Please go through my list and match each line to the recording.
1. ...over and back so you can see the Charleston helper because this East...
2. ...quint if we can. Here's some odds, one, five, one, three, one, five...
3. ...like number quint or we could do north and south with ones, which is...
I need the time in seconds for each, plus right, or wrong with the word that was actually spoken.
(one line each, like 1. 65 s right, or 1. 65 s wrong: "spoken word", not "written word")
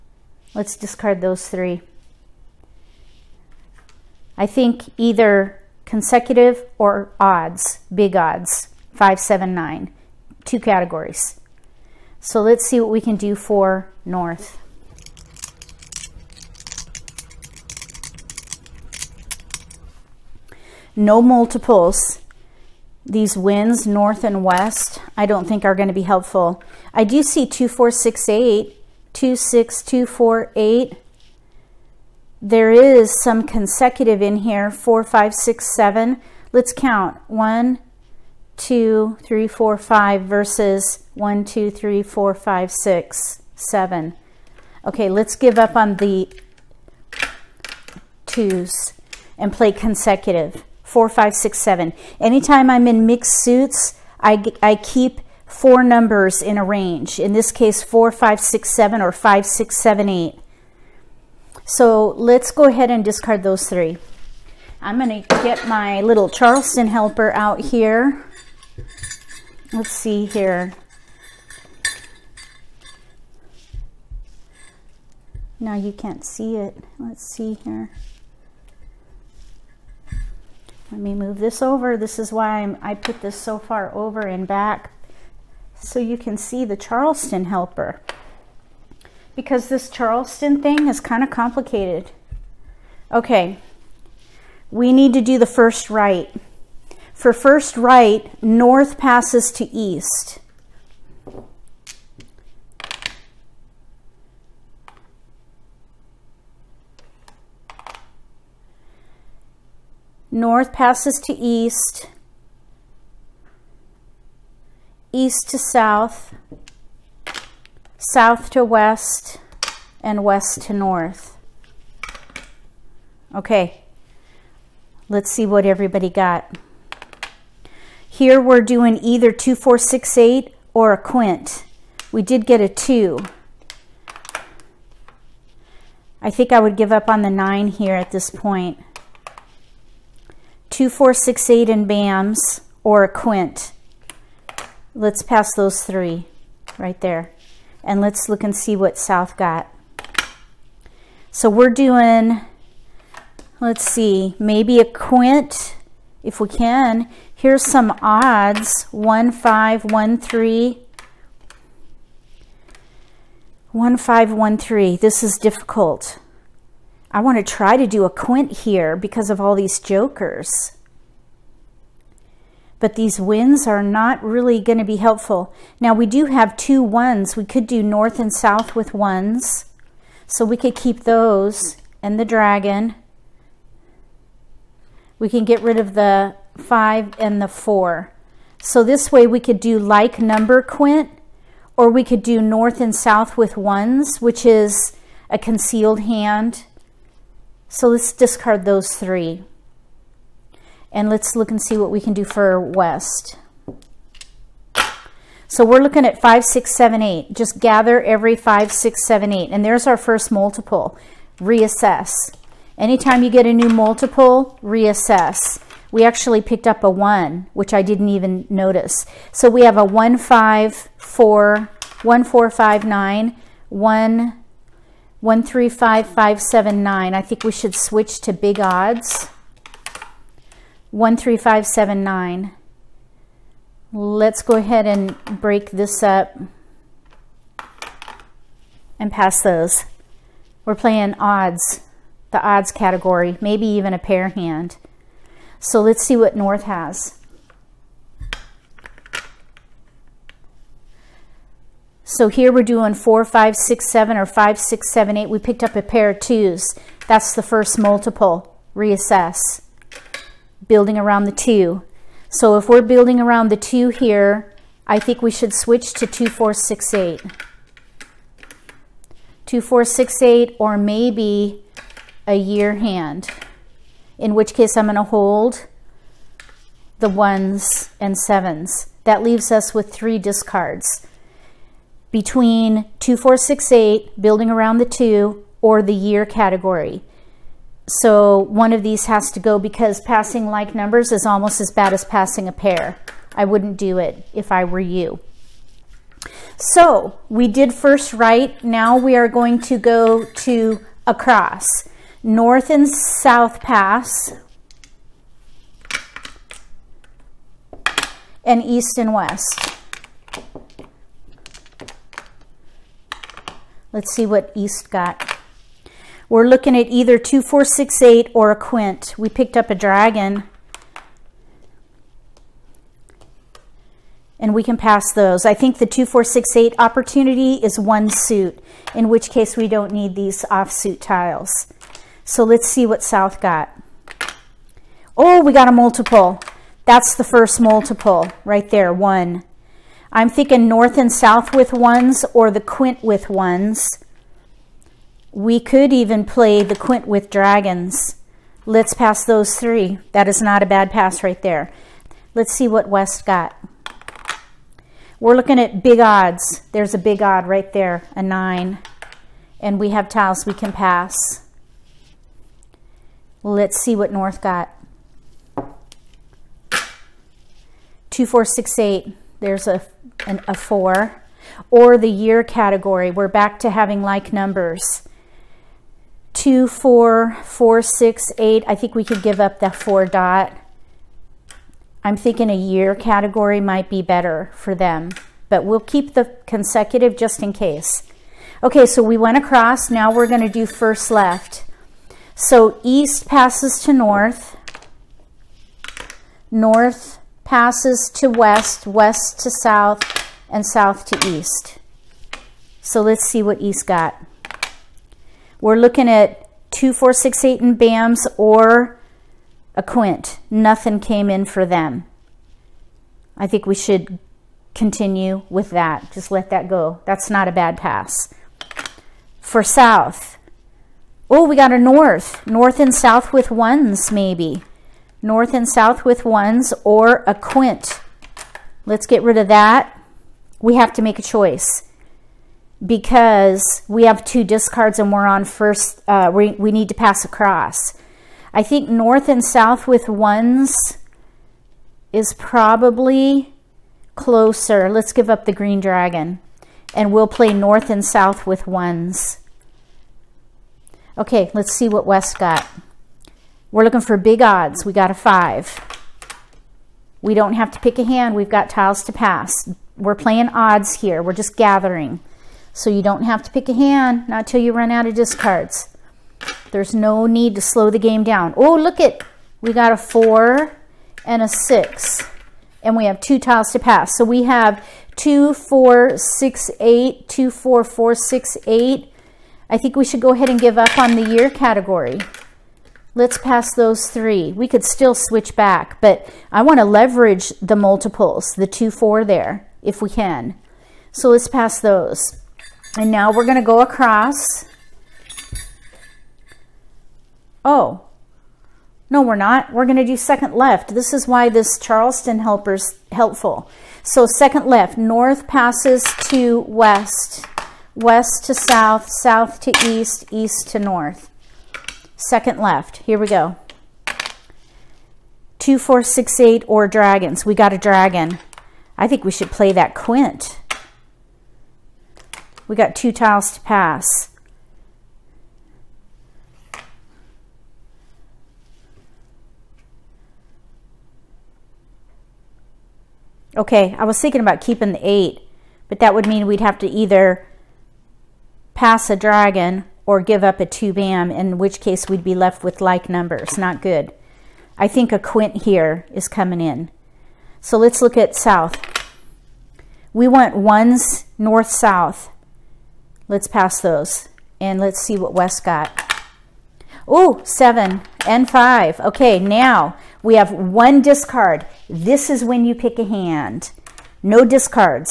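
1. 83 s wrong: "Charleston", not "East"
2. 154 s right
3. 189 s right.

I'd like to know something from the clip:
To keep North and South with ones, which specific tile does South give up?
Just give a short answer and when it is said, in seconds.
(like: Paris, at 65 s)
Green dragon, at 445 s.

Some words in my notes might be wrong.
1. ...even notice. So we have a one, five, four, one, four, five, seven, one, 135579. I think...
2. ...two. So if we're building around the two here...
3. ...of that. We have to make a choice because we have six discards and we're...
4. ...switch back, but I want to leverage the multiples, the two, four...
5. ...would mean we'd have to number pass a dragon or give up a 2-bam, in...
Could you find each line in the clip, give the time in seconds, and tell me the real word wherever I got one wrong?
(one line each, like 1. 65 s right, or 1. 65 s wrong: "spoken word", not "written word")
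1. 218 s wrong: "nine", not "seven"
2. 261 s right
3. 429 s wrong: "two", not "six"
4. 485 s right
5. 536 s wrong: "either", not "number".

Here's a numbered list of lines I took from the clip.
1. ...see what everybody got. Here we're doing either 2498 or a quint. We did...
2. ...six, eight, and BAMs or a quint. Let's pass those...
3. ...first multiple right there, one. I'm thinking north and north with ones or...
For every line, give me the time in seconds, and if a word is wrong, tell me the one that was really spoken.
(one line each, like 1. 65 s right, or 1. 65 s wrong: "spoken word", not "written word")
1. 125 s wrong: "2468", not "2498"
2. 141 s right
3. 337 s wrong: "south", not "north".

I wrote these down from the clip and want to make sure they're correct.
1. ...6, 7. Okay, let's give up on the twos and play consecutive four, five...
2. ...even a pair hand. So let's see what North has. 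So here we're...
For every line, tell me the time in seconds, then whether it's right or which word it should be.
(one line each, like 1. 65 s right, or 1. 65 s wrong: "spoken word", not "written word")
1. 42 s right
2. 243 s right.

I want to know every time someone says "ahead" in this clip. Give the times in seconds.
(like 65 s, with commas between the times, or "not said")
62 s, 234 s, 480 s.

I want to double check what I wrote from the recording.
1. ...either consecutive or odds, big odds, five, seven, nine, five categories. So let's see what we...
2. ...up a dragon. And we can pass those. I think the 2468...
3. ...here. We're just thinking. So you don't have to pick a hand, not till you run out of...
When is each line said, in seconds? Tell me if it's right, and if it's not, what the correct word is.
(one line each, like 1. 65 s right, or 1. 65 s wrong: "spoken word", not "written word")
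1. 4 s wrong: "two", not "five"
2. 319 s right
3. 460 s wrong: "gathering", not "thinking".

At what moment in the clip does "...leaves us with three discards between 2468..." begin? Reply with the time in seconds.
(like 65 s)
279 s.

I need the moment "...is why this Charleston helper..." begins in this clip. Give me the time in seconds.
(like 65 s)
501 s.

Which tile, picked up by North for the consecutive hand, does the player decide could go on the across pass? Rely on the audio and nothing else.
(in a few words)
Four dot.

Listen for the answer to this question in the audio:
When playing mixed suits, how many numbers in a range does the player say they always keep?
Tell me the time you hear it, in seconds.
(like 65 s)
55 s.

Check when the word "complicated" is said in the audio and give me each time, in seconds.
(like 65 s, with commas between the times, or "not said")
91 s.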